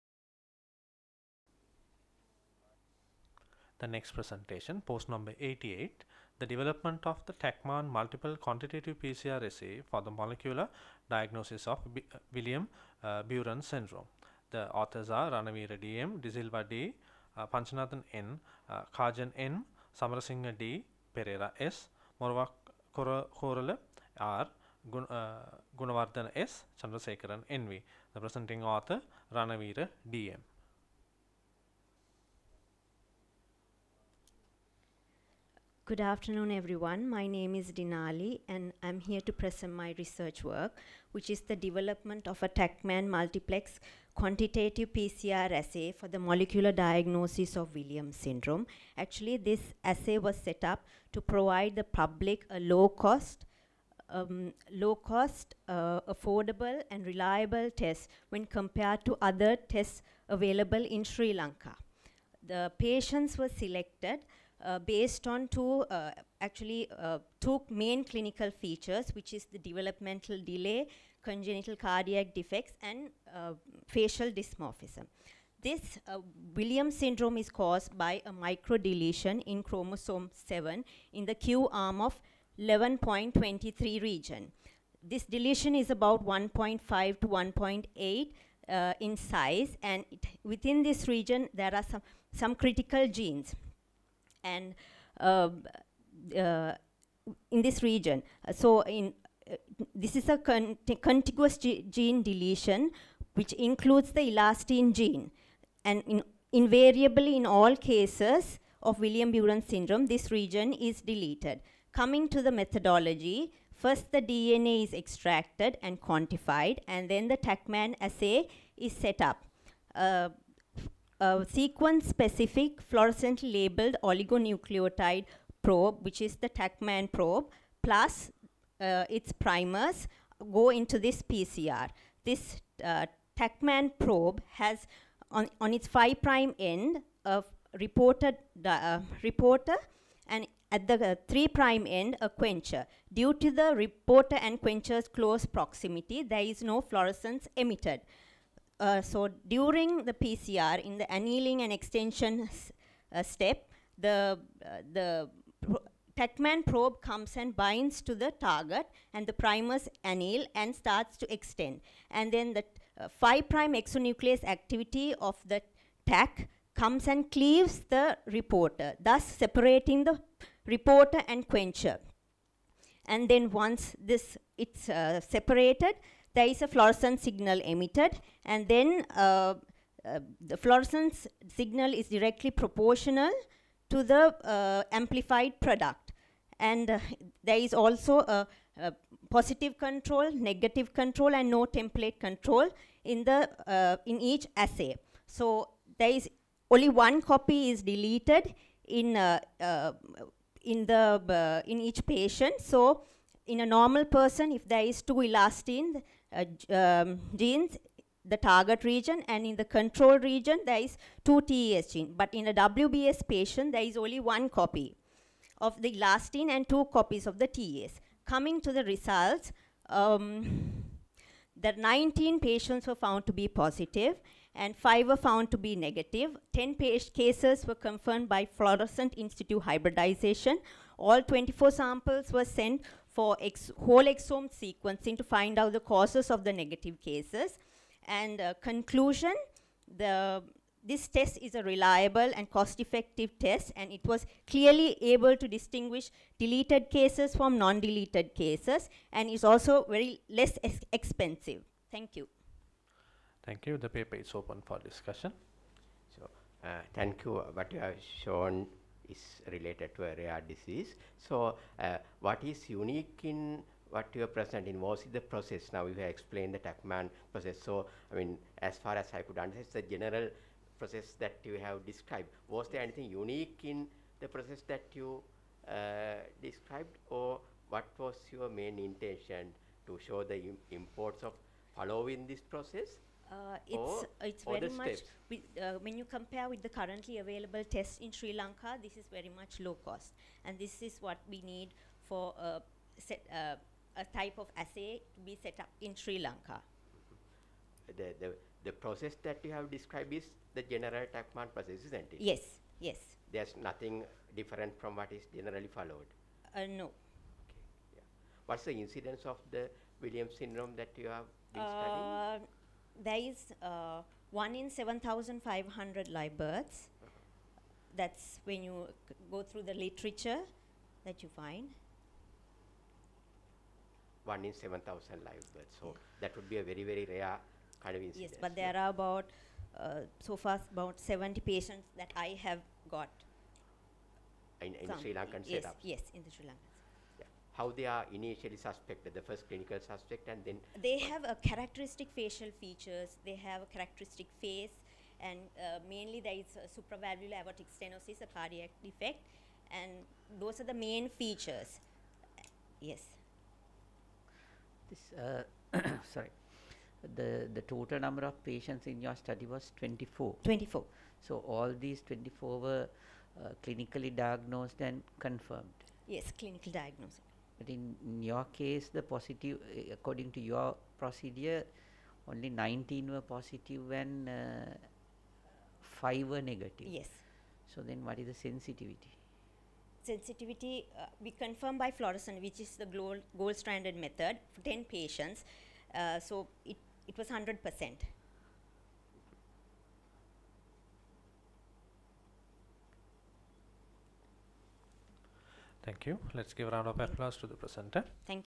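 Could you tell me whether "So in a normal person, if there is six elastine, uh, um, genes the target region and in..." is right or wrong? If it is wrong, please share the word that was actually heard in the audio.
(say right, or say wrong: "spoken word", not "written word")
wrong: "two", not "six".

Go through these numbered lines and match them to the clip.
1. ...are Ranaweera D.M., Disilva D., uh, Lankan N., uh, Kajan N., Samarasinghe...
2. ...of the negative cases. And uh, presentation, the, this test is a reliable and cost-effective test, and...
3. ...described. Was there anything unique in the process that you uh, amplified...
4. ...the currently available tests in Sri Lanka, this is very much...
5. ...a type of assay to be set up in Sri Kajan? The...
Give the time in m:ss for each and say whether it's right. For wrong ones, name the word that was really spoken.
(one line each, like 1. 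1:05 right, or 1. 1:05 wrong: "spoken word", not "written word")
1. 0:15 wrong: "Panchananthan", not "Lankan"
2. 3:56 wrong: "conclusion", not "presentation"
3. 4:31 wrong: "described", not "amplified"
4. 4:46 right
5. 4:53 wrong: "Lanka", not "Kajan".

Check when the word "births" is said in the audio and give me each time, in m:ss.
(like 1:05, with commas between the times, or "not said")
5:16, 5:25.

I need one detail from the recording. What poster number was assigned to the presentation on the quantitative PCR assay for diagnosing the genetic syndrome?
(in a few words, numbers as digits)
88.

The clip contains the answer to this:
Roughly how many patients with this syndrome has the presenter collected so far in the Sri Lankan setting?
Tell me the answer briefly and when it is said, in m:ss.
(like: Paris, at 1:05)
70, at 5:30.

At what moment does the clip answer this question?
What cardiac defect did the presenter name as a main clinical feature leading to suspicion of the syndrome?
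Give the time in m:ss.
5:46.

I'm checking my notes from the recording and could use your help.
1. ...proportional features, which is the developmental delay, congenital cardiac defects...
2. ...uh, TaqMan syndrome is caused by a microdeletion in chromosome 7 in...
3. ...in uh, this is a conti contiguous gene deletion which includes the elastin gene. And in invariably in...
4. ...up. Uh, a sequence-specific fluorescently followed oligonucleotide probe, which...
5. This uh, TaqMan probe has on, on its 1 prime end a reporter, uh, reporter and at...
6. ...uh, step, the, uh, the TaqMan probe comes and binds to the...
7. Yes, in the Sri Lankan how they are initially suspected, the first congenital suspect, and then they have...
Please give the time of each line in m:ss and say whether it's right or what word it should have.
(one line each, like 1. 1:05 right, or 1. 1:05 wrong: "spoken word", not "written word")
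1. 1:08 wrong: "clinical", not "proportional"
2. 1:16 wrong: "Williams", not "TaqMan"
3. 1:38 right
4. 1:59 wrong: "labeled", not "followed"
5. 2:12 wrong: "5", not "1"
6. 2:33 right
7. 5:35 wrong: "clinical", not "congenital".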